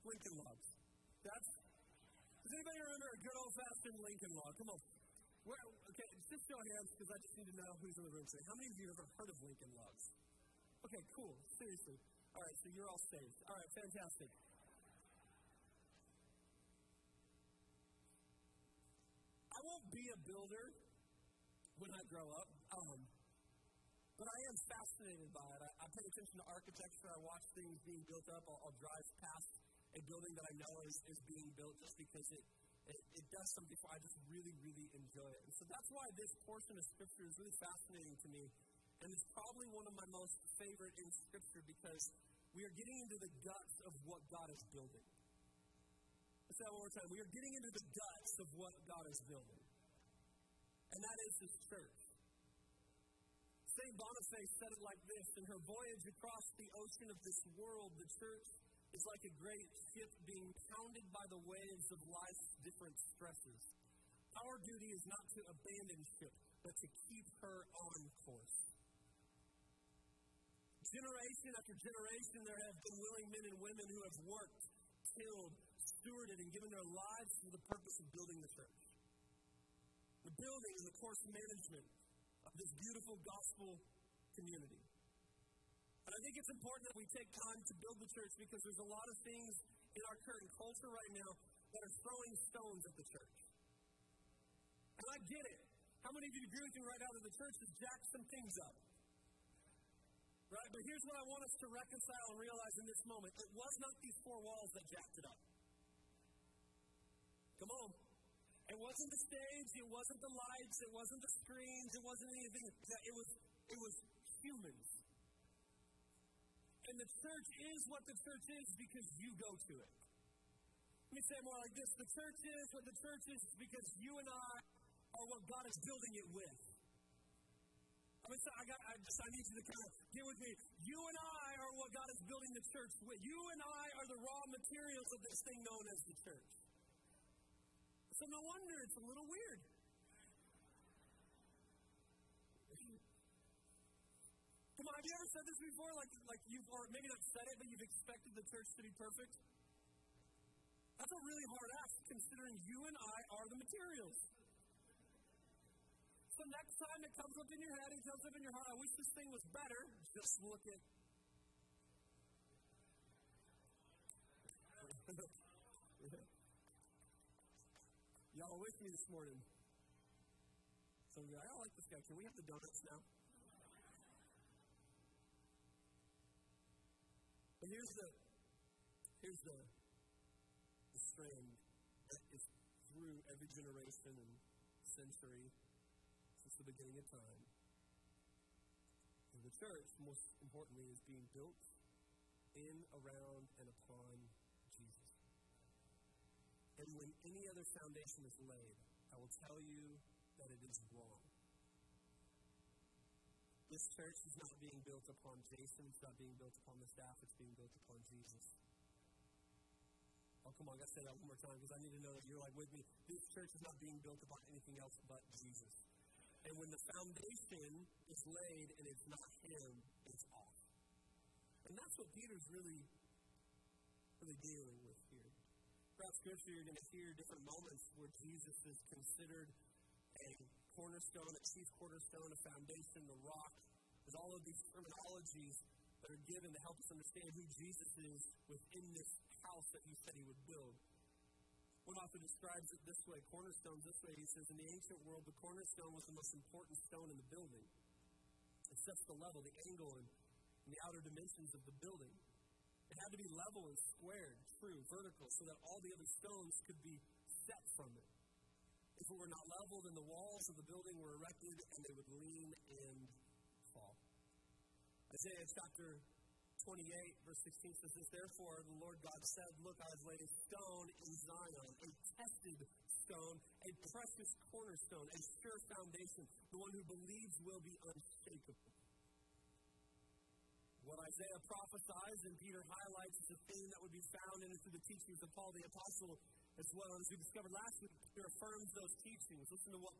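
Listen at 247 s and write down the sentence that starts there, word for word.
It sets the level, the angle, and the outer dimensions of the building.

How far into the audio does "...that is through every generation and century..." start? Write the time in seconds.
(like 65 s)
182 s.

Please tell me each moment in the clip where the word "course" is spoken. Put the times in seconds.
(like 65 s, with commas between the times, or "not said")
68 s, 81 s.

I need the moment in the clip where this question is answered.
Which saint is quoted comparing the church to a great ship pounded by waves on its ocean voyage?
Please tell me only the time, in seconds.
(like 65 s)
53 s.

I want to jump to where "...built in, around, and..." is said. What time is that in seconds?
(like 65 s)
191 s.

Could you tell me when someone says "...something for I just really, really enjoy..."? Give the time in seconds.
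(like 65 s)
33 s.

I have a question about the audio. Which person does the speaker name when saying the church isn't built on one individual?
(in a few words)
Jason.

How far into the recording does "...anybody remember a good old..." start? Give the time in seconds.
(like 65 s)
2 s.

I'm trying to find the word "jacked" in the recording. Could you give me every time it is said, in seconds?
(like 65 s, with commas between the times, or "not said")
97 s, 104 s.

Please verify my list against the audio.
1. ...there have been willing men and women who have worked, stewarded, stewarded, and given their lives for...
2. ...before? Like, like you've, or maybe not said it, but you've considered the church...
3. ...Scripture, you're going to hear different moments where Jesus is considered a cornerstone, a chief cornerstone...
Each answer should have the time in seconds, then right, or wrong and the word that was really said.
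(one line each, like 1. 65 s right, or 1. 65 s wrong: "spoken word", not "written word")
1. 72 s wrong: "killed", not "stewarded"
2. 145 s wrong: "expected", not "considered"
3. 226 s right.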